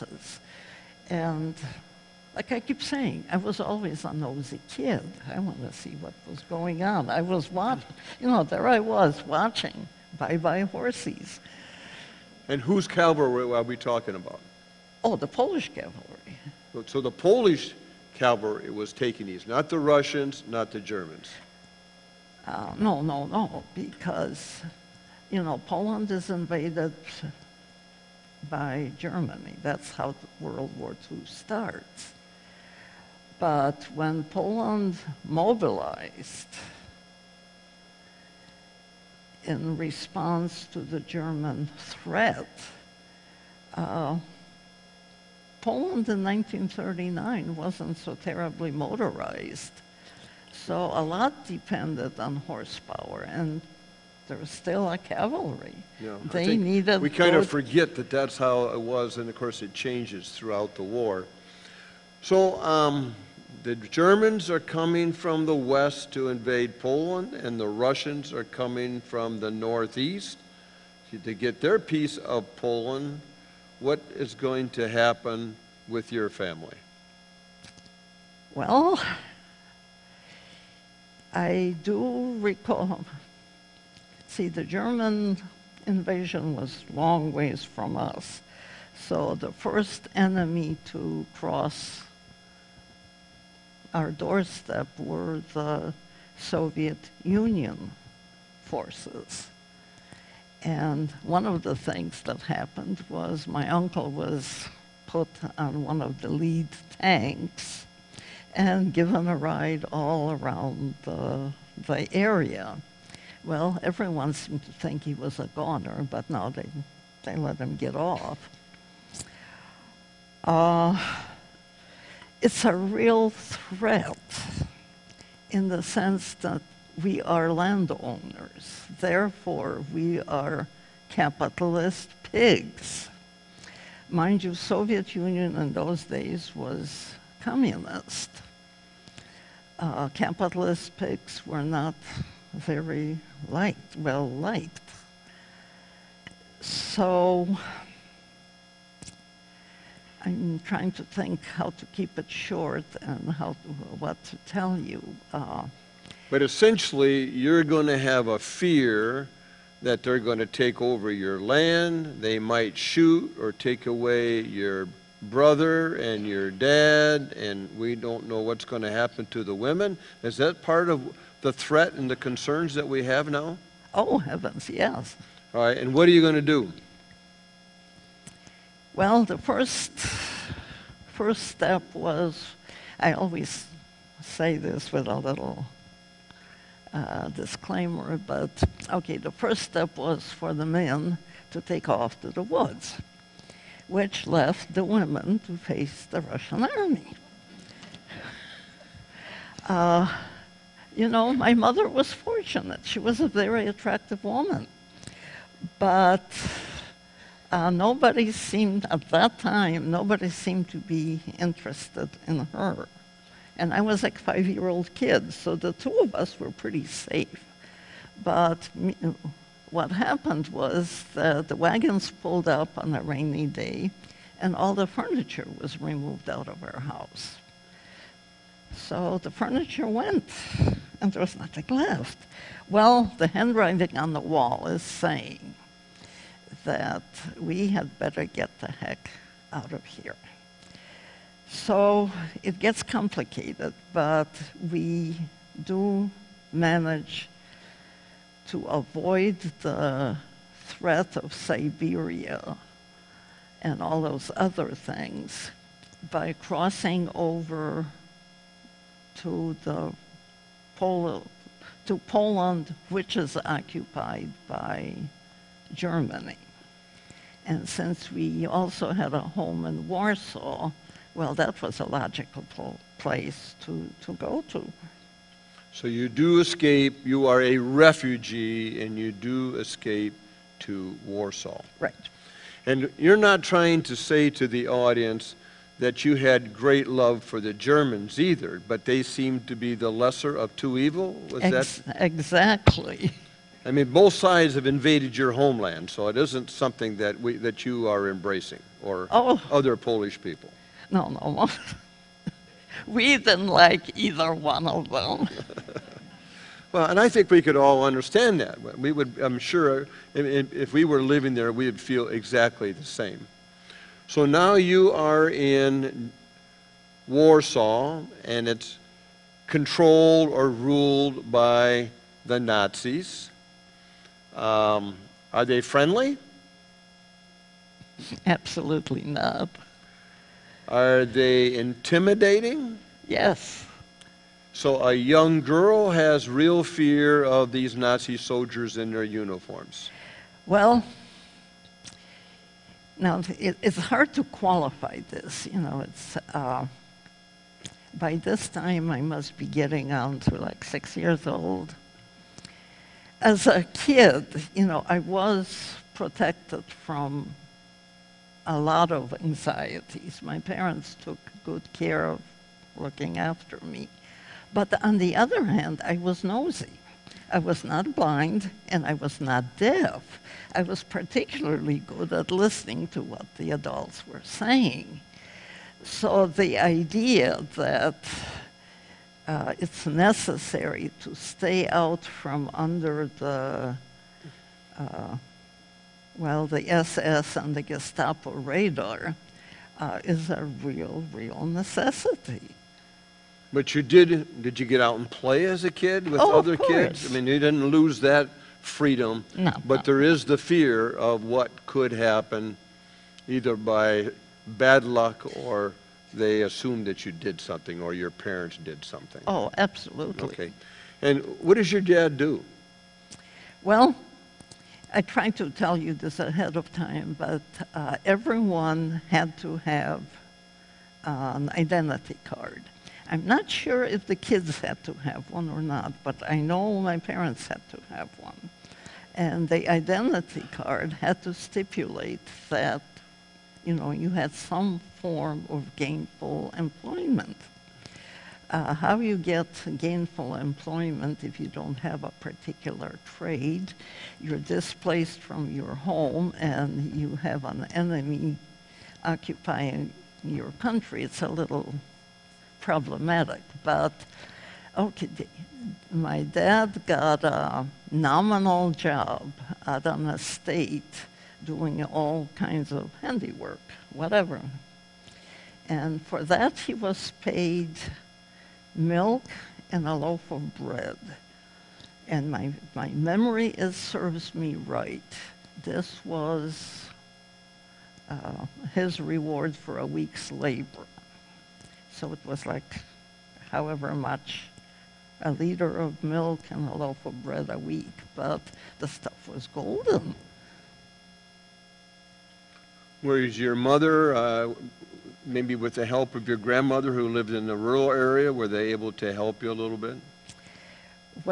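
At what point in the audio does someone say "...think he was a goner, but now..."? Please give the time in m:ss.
1:54.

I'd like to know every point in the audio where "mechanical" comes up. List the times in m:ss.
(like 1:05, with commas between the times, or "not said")
not said.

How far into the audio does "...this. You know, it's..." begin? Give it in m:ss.
5:45.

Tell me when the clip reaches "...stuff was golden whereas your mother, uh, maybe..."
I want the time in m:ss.
8:08.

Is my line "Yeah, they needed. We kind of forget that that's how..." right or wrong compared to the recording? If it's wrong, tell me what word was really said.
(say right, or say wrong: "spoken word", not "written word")
right.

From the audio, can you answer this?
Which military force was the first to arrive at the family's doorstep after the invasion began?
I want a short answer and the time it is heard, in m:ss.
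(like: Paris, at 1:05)
Soviet Union forces, at 1:36.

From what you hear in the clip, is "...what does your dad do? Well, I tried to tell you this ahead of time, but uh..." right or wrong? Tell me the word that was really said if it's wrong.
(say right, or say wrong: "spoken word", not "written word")
right.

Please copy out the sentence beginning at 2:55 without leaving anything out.
All right, and what are you going to do?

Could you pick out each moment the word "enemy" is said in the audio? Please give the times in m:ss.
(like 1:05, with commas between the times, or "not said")
1:30, 7:27.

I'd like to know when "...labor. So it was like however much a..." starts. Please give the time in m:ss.
8:00.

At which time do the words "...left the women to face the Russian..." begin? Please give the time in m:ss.
3:14.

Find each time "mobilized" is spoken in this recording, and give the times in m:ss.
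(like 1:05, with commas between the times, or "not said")
0:35.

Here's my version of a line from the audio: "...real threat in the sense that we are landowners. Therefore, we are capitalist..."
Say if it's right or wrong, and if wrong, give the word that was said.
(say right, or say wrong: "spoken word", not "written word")
right.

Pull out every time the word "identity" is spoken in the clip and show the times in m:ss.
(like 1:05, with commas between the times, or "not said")
7:01, 7:09.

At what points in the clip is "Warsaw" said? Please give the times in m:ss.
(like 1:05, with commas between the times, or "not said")
4:29, 4:41, 5:17.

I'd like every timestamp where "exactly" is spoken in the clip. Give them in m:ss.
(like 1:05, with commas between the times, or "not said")
4:51, 5:12.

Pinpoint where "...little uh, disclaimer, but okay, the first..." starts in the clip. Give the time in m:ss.
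3:05.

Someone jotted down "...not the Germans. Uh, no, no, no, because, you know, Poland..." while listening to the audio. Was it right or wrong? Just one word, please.
right.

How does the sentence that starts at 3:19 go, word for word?
Uh, you know, my mother was fortunate.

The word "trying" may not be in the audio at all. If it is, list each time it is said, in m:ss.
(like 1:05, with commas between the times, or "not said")
2:30, 4:43.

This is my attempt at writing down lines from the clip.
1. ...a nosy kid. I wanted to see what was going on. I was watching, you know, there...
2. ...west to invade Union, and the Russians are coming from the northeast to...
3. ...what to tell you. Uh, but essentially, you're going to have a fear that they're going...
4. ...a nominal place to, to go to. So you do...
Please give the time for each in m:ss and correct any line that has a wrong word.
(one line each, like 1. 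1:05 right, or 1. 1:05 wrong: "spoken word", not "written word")
1. 0:04 right
2. 1:05 wrong: "Poland", not "Union"
3. 2:33 right
4. 4:31 wrong: "logical", not "nominal".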